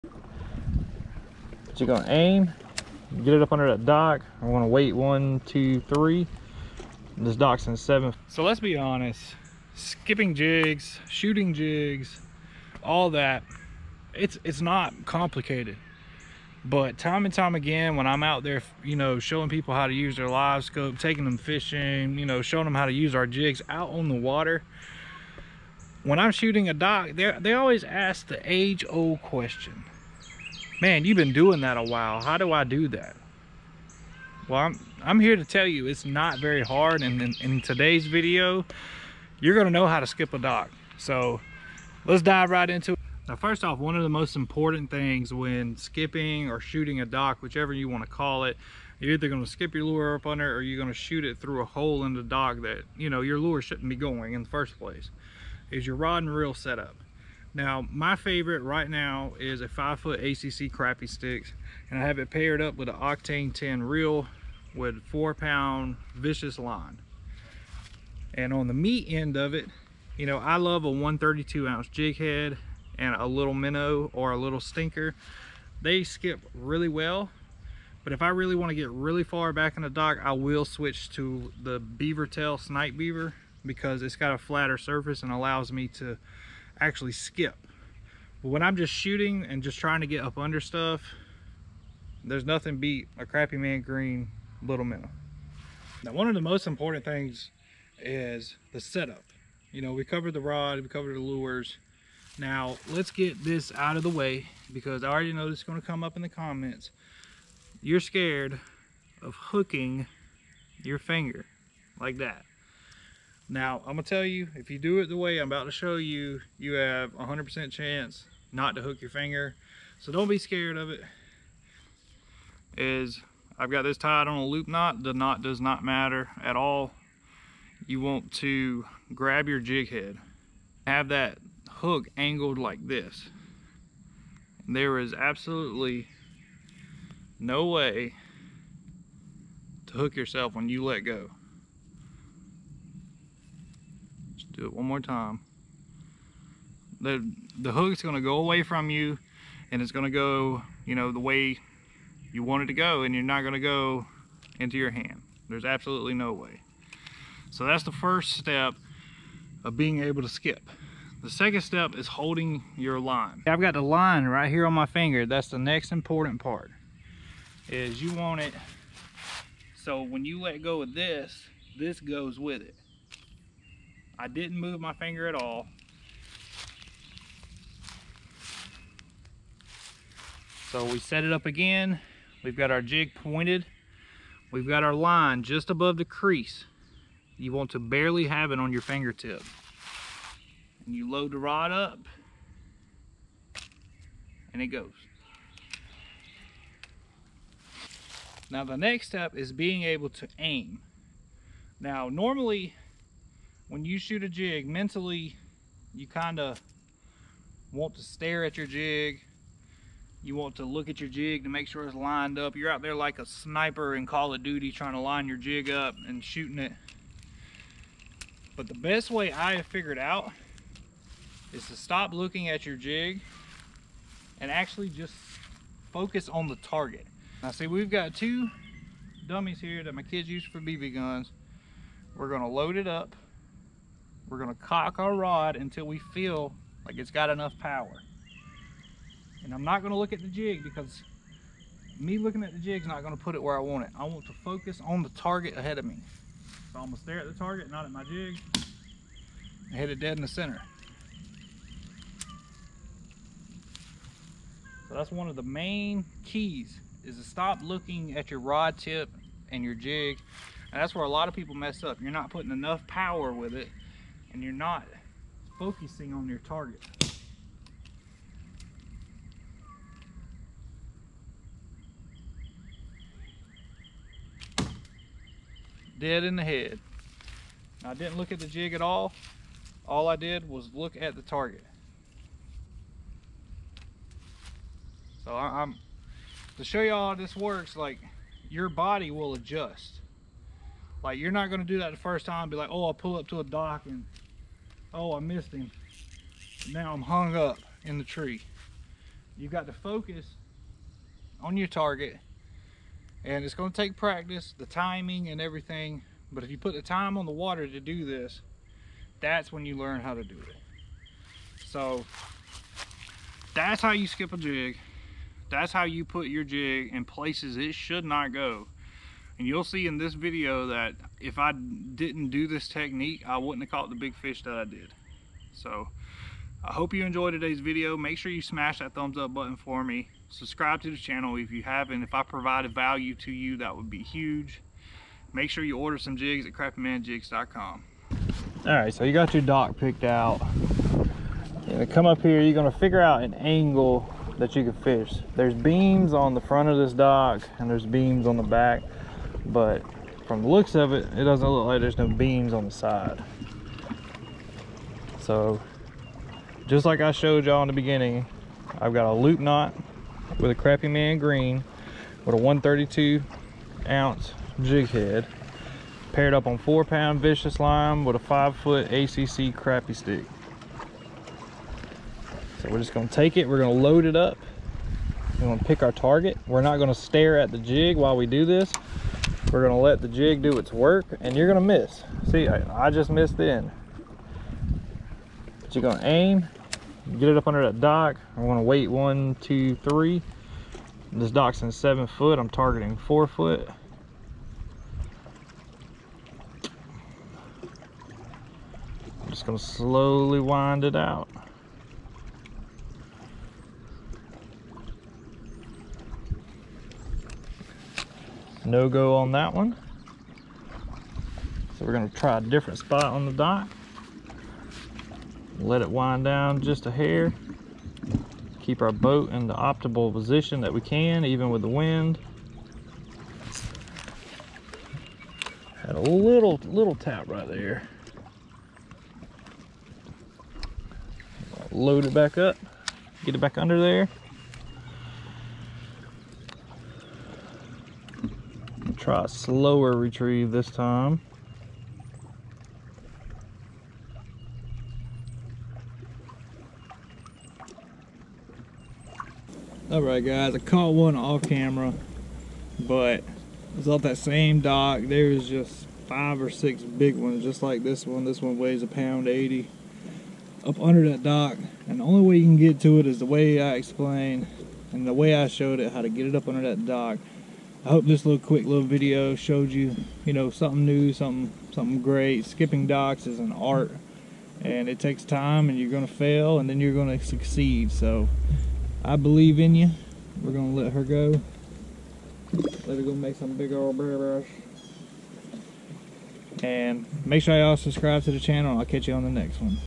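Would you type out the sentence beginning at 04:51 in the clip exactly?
Like you're not gonna do that the first time.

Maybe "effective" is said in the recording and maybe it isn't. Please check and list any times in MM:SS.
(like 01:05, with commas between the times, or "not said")
not said.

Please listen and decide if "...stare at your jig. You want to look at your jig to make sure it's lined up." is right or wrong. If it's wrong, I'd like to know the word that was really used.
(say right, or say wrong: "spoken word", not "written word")
right.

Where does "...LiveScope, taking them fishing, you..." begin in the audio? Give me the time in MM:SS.
00:20.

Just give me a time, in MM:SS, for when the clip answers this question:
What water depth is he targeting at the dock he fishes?
06:32.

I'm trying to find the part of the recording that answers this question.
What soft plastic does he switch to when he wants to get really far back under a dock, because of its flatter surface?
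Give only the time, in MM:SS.
01:21.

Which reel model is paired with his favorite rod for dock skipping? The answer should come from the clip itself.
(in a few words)
Octane 10.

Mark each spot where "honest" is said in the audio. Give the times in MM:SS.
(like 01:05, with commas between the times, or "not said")
00:08.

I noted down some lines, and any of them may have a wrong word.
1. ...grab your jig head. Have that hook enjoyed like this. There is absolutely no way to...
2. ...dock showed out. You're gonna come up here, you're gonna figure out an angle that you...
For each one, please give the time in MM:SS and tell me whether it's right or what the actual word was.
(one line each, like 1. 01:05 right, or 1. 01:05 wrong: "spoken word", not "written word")
1. 02:09 wrong: "angled", not "enjoyed"
2. 05:39 wrong: "picked", not "showed".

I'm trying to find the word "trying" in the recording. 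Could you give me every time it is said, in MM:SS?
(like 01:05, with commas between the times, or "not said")
01:29, 03:34.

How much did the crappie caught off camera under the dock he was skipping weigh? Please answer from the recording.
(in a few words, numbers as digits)
a pound 80.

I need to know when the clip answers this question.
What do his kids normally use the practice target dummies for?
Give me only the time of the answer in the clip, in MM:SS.
03:50.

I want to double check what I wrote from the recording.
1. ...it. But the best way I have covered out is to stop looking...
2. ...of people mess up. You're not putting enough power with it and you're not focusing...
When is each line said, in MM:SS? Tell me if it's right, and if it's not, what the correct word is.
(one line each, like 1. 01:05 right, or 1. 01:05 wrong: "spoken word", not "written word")
1. 03:36 wrong: "figured", not "covered"
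2. 04:21 right.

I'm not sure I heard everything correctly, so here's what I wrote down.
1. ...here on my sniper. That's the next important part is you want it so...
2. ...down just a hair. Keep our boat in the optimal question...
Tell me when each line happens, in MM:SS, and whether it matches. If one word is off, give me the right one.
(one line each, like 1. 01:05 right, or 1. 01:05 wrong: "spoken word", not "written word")
1. 02:44 wrong: "finger", not "sniper"
2. 06:56 wrong: "position", not "question".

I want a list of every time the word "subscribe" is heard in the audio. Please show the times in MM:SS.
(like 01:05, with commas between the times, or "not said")
05:30, 08:07.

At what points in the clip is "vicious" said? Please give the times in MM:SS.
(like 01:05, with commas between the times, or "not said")
01:06, 06:07.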